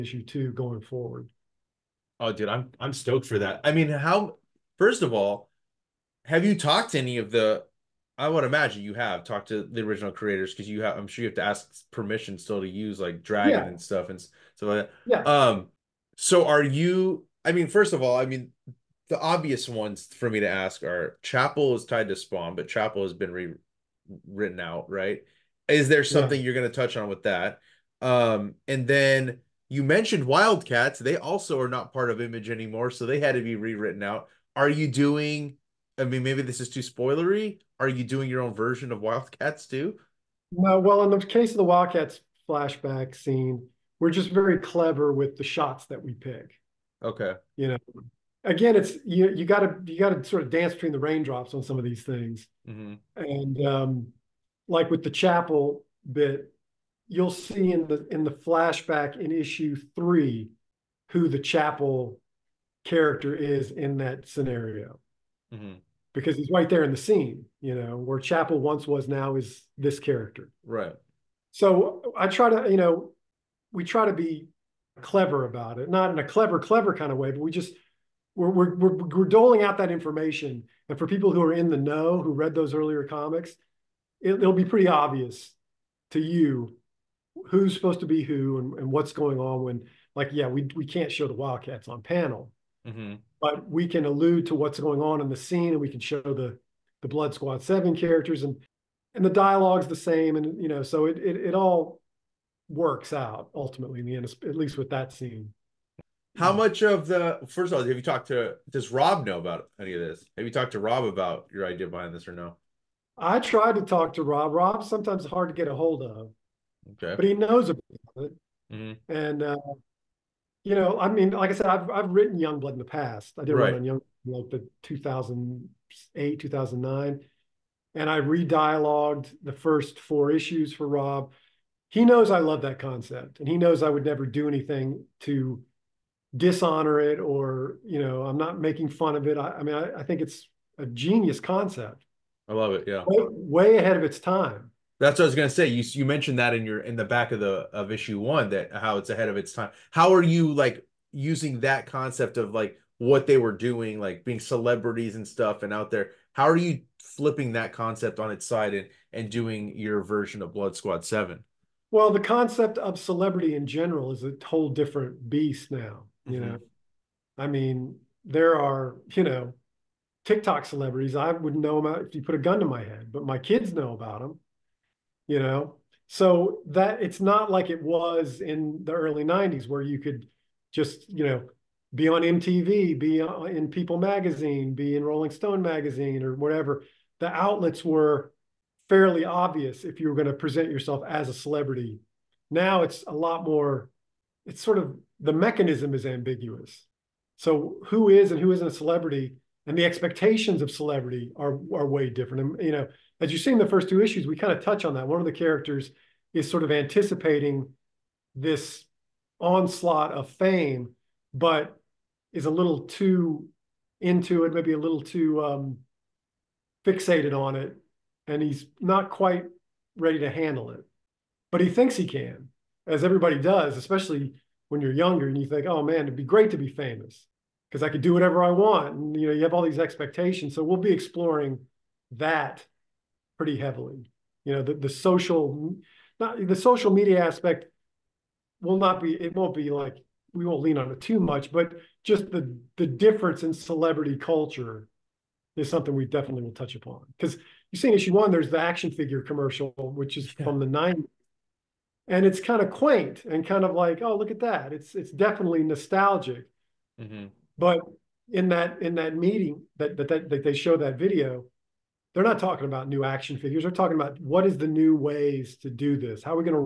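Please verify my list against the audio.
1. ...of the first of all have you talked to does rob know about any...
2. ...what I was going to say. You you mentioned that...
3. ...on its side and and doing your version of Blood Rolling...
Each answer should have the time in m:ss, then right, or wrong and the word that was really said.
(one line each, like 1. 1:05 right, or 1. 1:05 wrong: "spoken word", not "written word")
1. 1:46 right
2. 2:25 right
3. 2:38 wrong: "Squad", not "Rolling".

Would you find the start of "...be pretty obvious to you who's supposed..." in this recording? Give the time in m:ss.
1:24.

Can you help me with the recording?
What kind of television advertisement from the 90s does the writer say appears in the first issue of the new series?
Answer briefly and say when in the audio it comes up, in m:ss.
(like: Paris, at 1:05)
Action figure commercial, at 4:08.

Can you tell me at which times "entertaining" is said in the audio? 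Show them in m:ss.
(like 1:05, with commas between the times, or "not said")
not said.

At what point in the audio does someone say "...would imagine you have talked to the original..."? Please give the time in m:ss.
0:08.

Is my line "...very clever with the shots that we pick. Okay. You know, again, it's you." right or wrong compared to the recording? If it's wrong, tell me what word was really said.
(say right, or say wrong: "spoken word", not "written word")
right.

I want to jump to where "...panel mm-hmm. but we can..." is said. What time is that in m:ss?
1:32.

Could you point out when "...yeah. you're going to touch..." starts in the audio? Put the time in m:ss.
0:26.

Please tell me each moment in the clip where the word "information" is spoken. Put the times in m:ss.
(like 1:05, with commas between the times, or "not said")
1:19.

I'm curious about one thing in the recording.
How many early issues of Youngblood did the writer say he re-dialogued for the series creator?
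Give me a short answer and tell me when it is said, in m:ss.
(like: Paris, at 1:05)
4, at 2:09.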